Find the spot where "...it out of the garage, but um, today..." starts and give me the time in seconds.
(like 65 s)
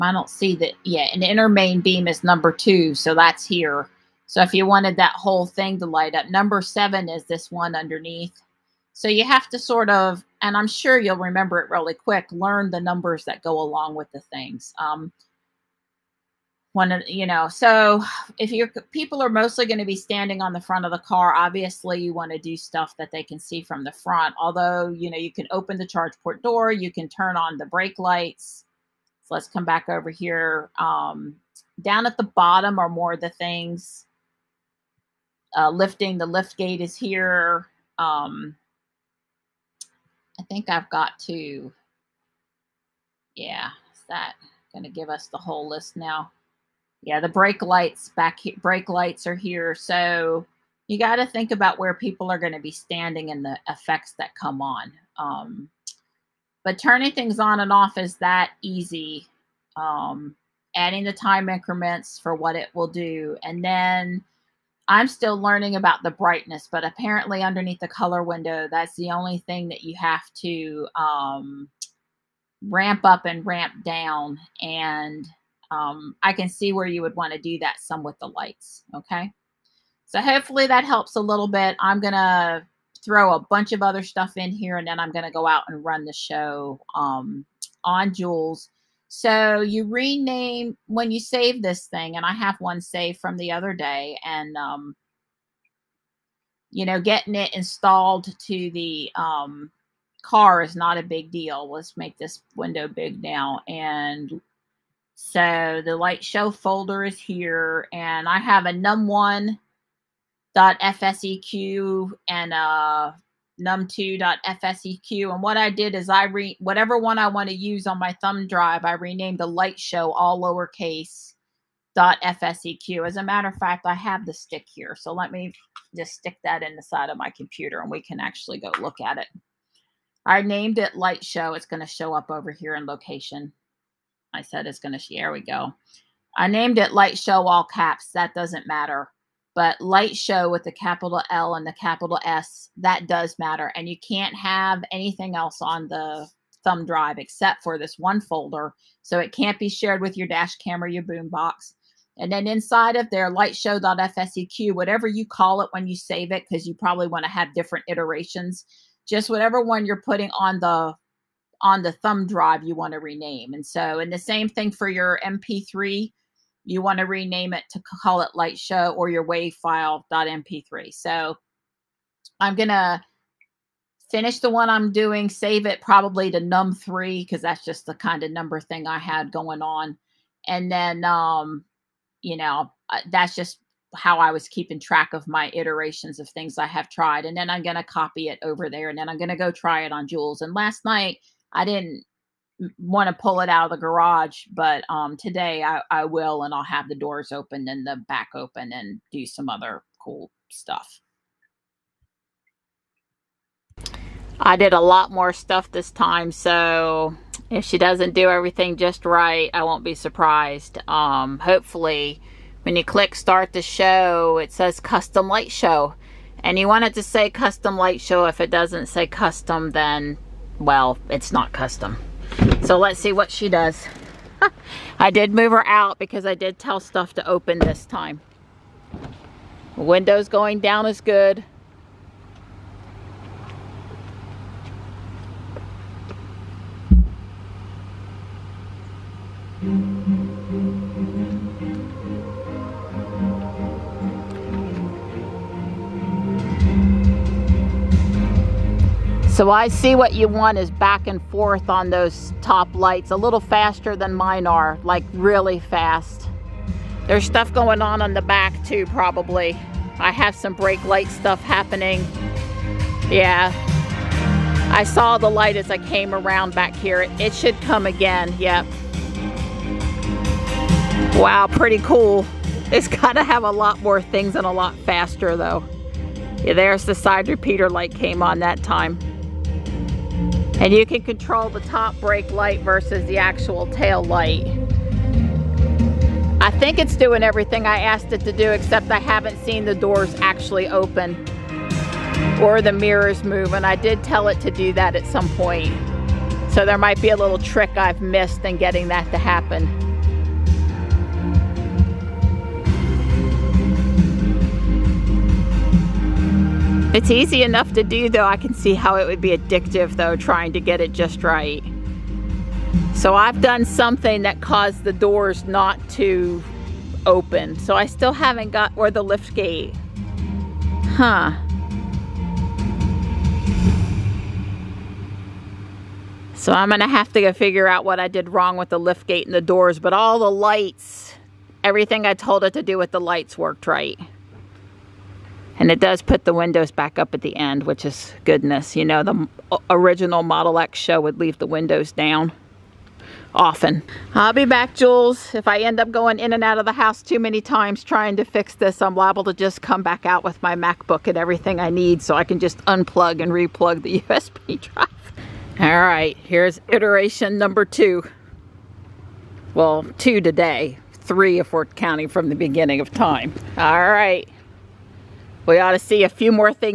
193 s.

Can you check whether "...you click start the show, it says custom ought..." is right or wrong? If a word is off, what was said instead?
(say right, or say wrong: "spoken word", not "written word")
wrong: "light", not "ought".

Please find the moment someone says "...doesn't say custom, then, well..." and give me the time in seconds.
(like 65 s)
218 s.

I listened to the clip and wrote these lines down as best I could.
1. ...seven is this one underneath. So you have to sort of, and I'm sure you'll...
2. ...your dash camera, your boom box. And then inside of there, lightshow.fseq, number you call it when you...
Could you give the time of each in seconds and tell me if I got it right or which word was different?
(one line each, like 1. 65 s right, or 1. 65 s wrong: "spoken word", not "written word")
1. 6 s right
2. 150 s wrong: "whatever", not "number".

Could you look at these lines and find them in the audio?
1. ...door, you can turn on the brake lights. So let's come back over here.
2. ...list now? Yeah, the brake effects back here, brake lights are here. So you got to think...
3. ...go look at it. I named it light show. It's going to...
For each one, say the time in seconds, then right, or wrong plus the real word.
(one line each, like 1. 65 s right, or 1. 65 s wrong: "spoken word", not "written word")
1. 26 s right
2. 45 s wrong: "lights", not "effects"
3. 128 s right.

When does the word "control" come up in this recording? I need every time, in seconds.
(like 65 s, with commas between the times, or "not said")
281 s.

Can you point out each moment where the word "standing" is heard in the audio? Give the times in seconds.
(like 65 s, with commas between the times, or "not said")
19 s, 52 s.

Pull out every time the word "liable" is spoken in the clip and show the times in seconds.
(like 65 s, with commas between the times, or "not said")
348 s.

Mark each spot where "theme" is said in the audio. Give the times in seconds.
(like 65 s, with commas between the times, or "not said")
not said.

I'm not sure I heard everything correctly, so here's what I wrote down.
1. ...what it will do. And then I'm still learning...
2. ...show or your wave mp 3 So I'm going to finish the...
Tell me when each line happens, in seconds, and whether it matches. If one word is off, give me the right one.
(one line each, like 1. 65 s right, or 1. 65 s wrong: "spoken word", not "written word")
1. 62 s right
2. 168 s right.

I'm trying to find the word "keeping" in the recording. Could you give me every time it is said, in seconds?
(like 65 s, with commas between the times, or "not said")
184 s.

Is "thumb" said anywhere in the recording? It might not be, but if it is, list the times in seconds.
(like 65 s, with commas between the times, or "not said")
118 s, 146 s, 161 s.